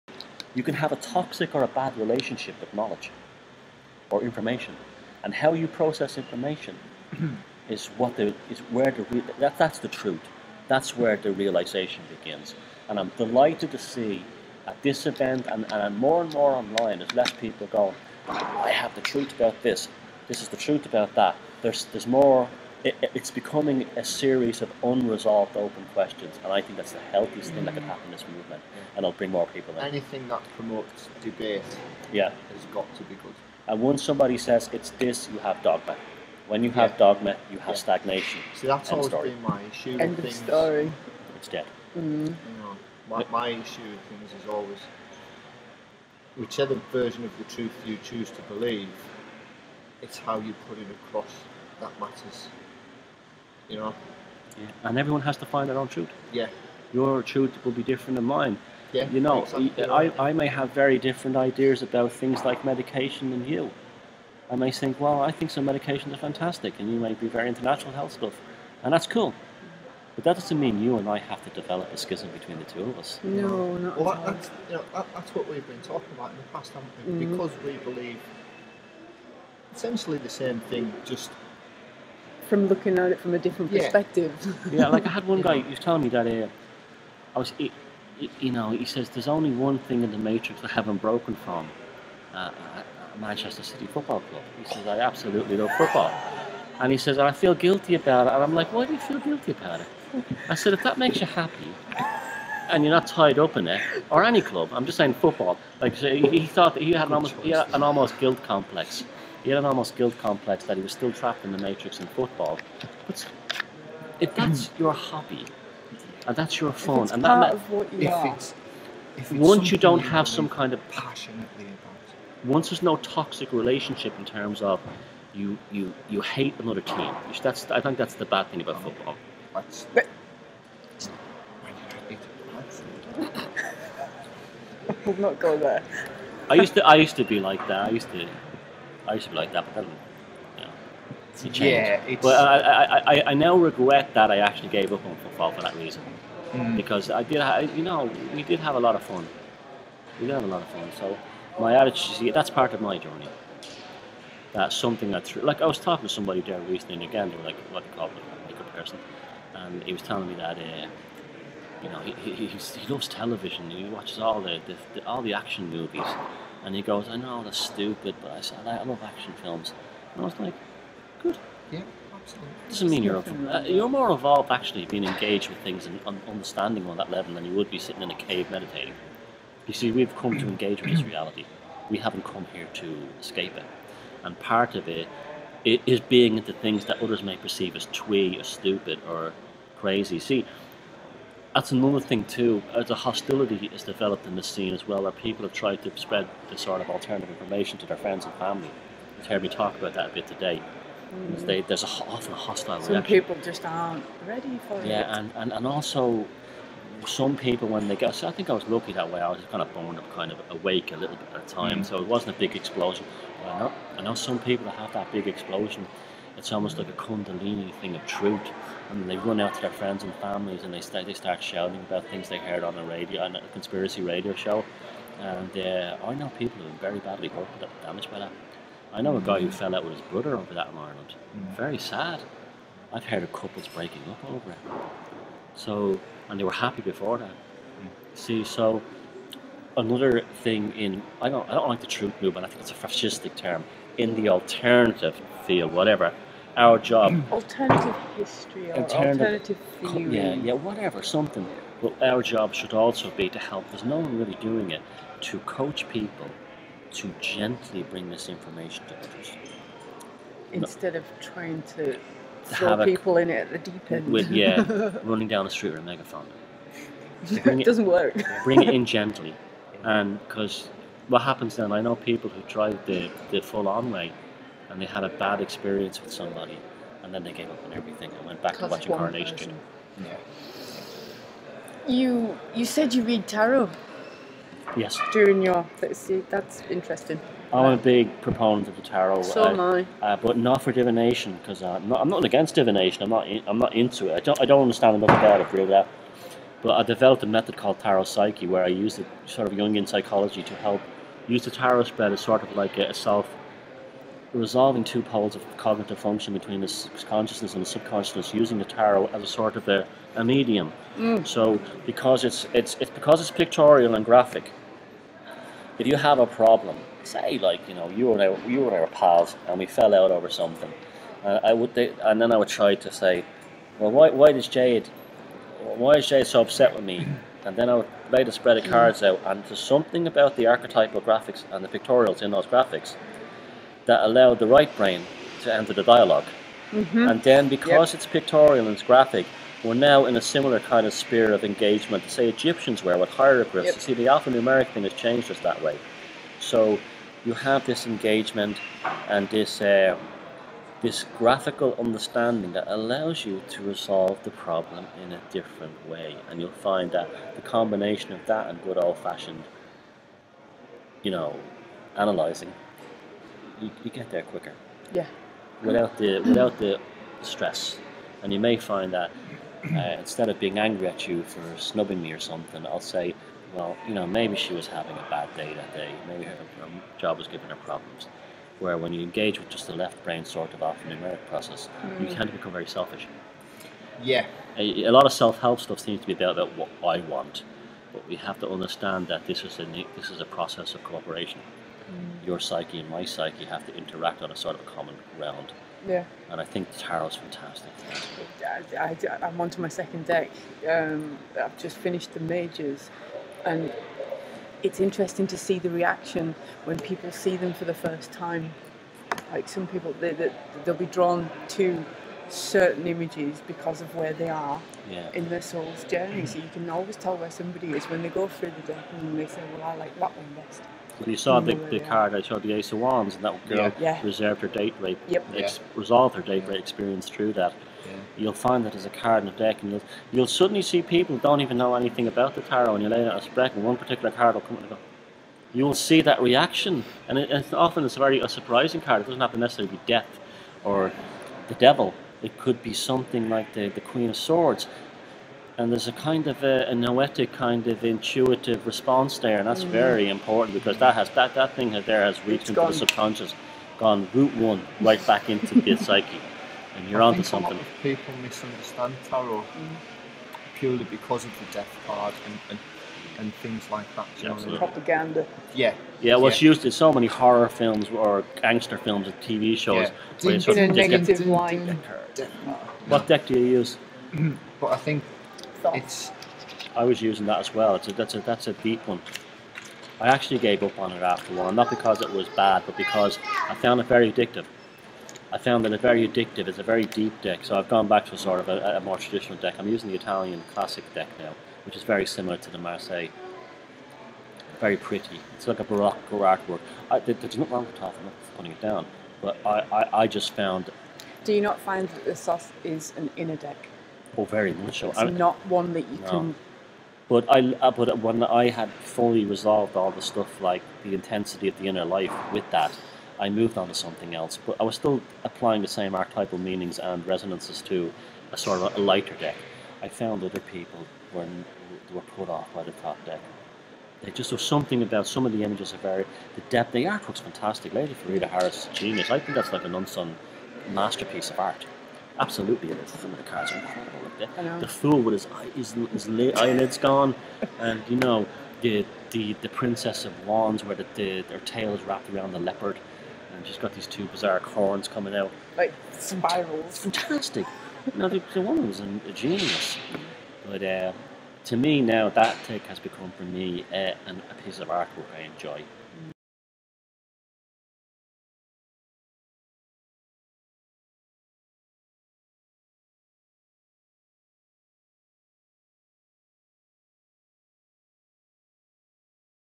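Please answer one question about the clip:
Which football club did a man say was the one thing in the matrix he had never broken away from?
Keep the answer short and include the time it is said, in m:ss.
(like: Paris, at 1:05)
Manchester City, at 1:33.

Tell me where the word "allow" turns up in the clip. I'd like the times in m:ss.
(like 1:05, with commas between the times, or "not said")
5:34, 5:52.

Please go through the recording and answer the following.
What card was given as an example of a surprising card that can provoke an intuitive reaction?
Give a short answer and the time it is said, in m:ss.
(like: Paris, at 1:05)
Queen of Swords, at 7:23.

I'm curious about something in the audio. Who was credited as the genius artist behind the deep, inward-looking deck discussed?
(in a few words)
Lady Frieda Harris.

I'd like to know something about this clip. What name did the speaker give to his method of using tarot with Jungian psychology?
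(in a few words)
tarot psyche.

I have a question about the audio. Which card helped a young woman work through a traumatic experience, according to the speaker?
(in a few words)
Ace of Wands.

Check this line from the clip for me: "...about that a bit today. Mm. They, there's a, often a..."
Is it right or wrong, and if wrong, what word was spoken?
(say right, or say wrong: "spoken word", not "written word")
right.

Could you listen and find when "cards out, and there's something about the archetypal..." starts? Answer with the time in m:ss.
5:28.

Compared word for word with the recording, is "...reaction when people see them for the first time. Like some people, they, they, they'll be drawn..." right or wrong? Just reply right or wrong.
right.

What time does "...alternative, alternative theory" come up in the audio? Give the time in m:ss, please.
4:08.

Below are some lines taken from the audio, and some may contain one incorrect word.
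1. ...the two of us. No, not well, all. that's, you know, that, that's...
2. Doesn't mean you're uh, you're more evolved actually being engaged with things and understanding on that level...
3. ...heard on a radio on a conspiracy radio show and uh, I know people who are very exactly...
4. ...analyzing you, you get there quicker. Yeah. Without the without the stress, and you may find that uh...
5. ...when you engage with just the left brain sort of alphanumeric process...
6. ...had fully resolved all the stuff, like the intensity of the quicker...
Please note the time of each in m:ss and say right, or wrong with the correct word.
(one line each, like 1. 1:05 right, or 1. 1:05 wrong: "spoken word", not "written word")
1. 1:12 right
2. 2:52 right
3. 3:42 wrong: "badly", not "exactly"
4. 6:02 right
5. 6:18 right
6. 8:28 wrong: "inner", not "quicker".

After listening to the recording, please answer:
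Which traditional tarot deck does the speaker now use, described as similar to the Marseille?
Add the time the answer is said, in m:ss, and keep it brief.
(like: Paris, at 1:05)
Italian classic deck, at 8:09.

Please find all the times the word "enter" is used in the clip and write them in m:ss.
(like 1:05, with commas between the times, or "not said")
5:35.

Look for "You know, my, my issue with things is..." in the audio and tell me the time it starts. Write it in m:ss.
0:42.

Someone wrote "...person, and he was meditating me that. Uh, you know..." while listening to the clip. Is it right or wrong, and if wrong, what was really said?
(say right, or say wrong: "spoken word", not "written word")
wrong: "telling", not "meditating".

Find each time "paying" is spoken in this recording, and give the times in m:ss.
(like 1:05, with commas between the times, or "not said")
not said.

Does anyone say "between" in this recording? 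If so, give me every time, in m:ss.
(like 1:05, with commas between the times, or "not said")
1:12, 5:06.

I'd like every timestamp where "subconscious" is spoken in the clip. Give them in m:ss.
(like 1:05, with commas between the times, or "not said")
5:07, 7:32.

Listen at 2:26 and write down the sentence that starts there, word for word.
because I did, ha- you know, we did have a lot of fun.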